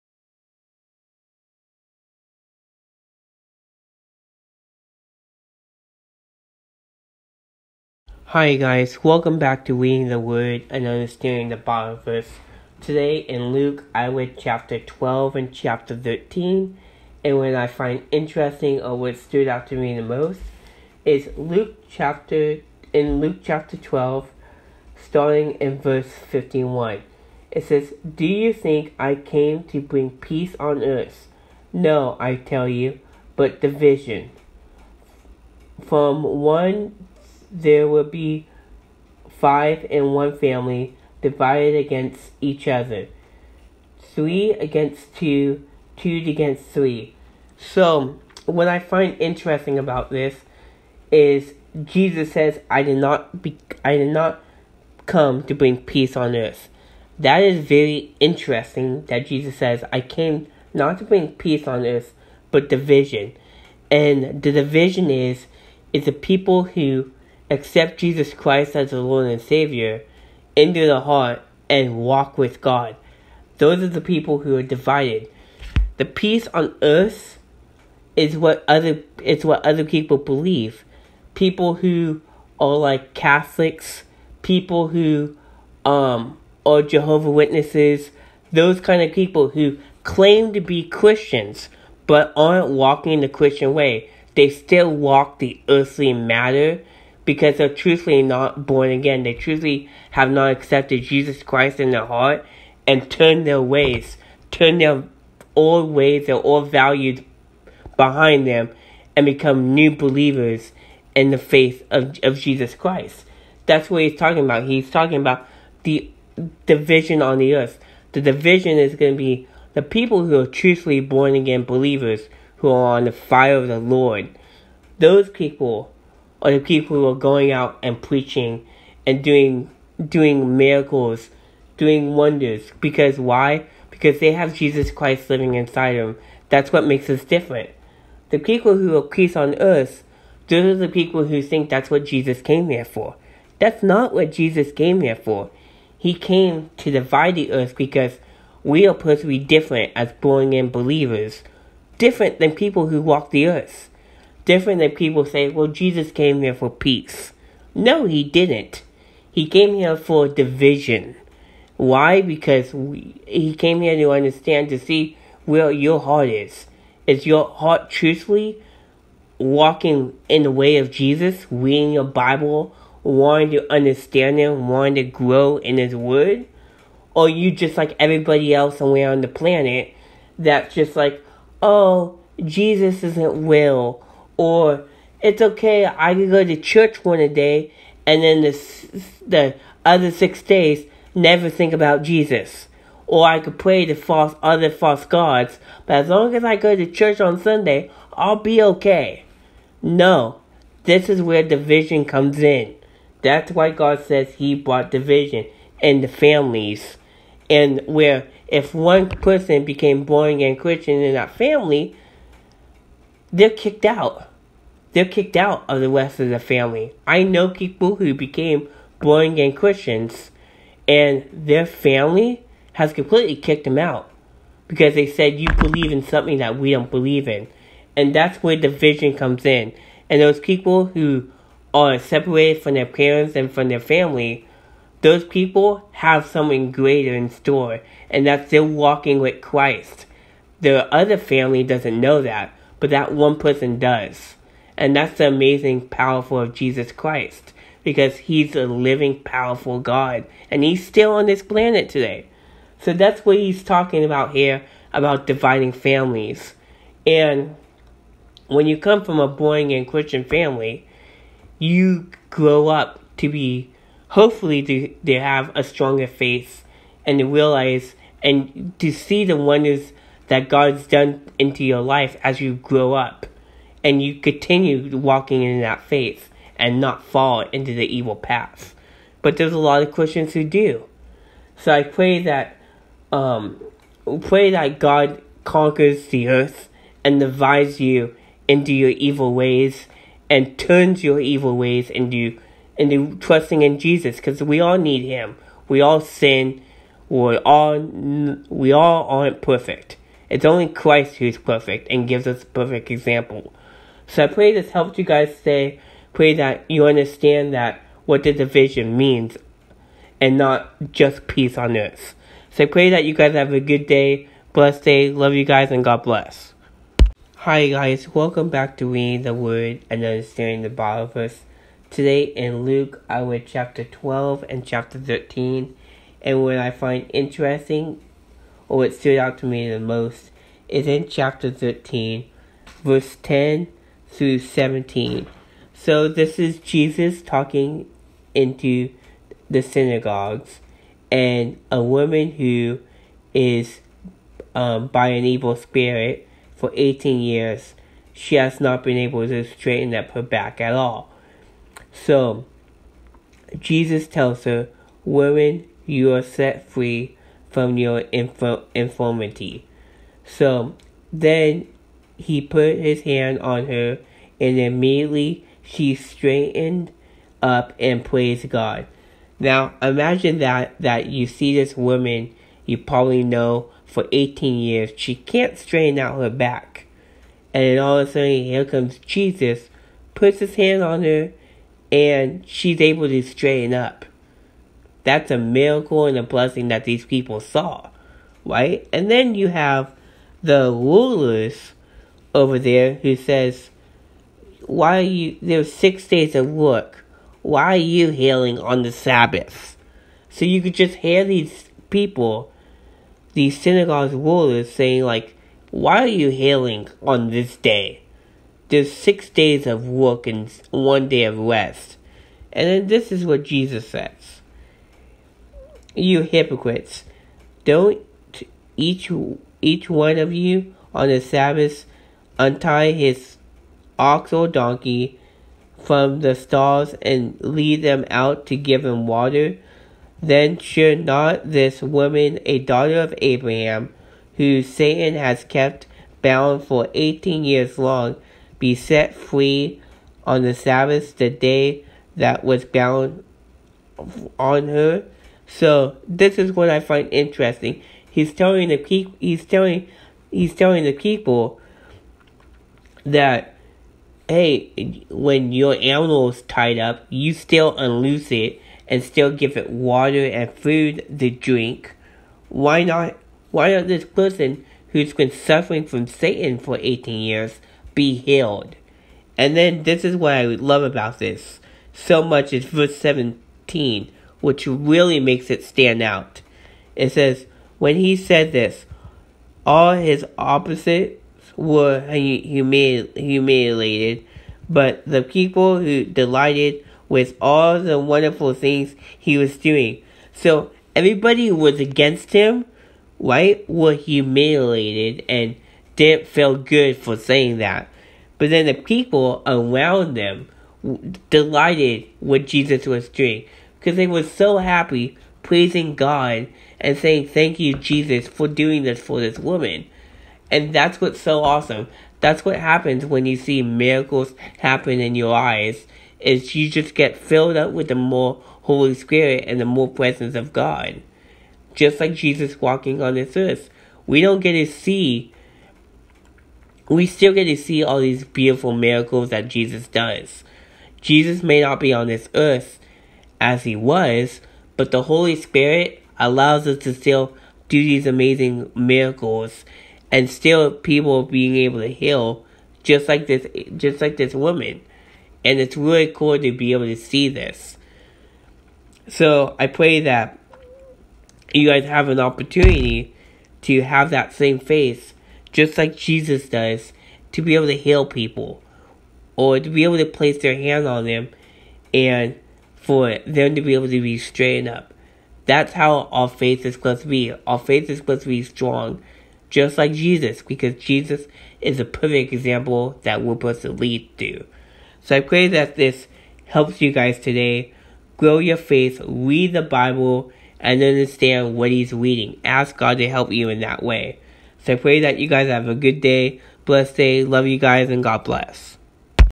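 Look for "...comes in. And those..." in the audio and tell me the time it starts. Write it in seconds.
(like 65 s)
229 s.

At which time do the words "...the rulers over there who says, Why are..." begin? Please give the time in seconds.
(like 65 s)
390 s.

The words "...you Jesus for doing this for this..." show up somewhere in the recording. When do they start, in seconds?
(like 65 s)
507 s.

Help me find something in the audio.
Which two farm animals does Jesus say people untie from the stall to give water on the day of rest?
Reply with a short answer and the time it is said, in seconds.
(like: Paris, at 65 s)
Ox or donkey, at 423 s.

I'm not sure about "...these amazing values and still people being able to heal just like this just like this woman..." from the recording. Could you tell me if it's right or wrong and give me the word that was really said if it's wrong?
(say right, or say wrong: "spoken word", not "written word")
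wrong: "miracles", not "values".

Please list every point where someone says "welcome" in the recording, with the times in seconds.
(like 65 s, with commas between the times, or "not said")
9 s, 318 s.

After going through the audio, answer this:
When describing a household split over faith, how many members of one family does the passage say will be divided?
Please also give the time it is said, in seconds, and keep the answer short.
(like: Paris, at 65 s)
5, at 39 s.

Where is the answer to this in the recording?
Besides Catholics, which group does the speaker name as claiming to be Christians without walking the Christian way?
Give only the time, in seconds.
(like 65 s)
86 s.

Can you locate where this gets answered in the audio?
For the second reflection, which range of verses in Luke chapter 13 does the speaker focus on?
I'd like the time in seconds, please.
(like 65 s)
333 s.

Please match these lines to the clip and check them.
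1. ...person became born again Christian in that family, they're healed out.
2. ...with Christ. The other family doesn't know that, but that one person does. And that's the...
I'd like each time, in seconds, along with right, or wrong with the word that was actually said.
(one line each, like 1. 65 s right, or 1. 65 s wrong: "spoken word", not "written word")
1. 209 s wrong: "kicked", not "healed"
2. 239 s right.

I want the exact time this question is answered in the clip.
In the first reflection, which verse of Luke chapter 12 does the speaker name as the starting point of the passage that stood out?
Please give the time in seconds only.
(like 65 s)
25 s.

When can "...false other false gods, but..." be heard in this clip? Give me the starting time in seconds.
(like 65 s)
193 s.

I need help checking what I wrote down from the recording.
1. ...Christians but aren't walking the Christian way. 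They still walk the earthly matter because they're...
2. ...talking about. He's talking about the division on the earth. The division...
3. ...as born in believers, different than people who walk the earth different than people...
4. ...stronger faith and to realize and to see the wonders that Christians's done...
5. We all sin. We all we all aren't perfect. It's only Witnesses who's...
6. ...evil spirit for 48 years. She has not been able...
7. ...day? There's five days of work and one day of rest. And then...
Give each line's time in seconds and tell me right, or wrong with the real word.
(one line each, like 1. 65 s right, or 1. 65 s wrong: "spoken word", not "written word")
1. 90 s right
2. 114 s right
3. 149 s right
4. 265 s wrong: "God", not "Christians"
5. 295 s wrong: "Christ", not "Witnesses"
6. 345 s wrong: "18", not "48"
7. 407 s wrong: "six", not "five".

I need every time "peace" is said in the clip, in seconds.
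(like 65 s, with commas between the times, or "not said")
30 s, 55 s, 61 s, 76 s, 139 s, 156 s, 311 s.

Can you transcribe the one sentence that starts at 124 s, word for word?
Those people or the people who are going out and preaching and doing doing miracles, doing wonders.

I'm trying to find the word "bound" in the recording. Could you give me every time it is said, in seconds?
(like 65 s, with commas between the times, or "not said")
436 s, 442 s.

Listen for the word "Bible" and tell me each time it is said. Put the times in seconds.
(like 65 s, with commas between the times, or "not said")
11 s, 172 s, 320 s, 579 s.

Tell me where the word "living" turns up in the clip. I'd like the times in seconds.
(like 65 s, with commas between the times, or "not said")
135 s, 248 s.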